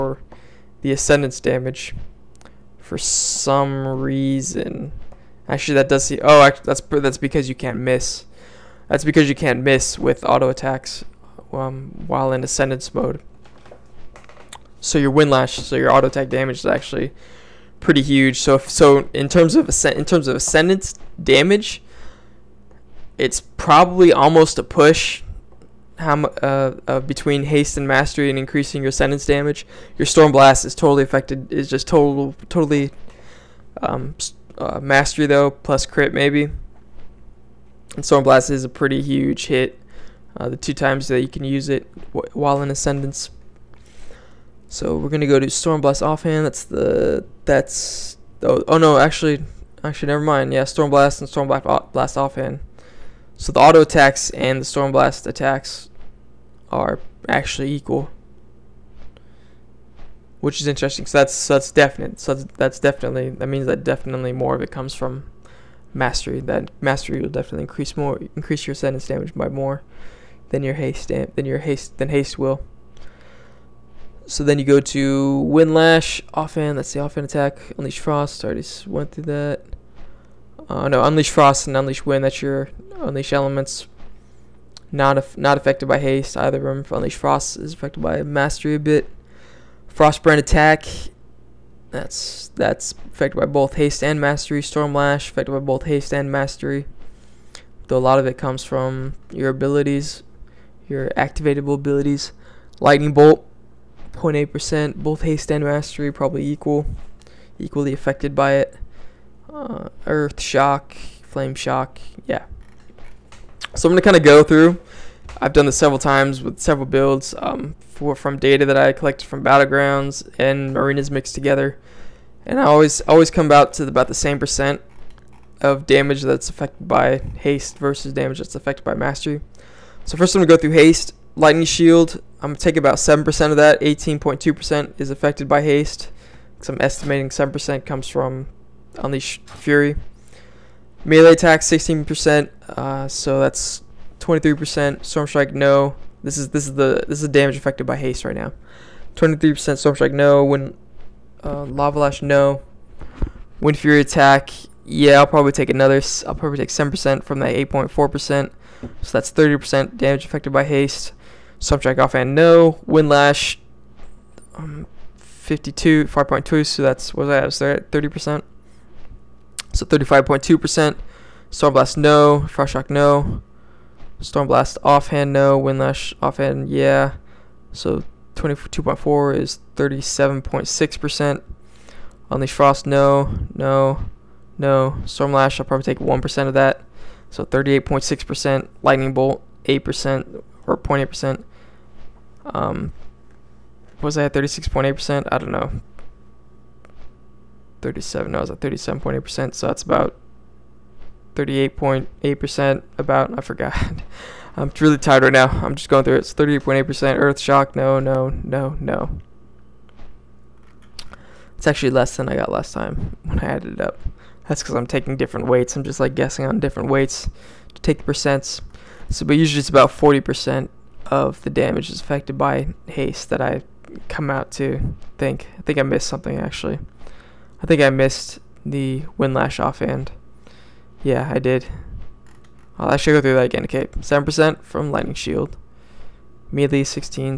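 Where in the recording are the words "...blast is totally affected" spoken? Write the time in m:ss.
0:30.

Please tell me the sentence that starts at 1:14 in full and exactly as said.
So then you go to Windlash, offhand, that's the offhand attack, Unleash Frost, already went through that.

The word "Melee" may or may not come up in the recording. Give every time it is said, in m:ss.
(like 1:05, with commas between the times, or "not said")
2:21, 3:56.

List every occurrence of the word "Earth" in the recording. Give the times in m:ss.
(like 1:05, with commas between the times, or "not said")
1:50, 3:27.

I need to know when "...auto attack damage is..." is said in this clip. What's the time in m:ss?
0:15.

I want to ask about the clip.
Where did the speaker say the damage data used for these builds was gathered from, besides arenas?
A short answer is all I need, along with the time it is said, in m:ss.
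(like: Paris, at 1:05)
Battlegrounds, at 1:59.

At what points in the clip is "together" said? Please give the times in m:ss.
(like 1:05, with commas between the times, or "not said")
2:01.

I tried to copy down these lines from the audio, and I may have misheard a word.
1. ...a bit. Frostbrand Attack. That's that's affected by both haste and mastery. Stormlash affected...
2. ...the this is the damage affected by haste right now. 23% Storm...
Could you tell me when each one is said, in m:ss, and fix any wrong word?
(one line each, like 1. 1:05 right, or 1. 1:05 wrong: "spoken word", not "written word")
1. 1:28 right
2. 2:26 right.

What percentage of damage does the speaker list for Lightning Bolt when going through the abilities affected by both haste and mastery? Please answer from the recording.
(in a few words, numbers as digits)
0.8%.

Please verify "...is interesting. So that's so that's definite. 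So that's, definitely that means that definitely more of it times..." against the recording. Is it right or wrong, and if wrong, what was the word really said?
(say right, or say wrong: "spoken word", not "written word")
wrong: "comes", not "times".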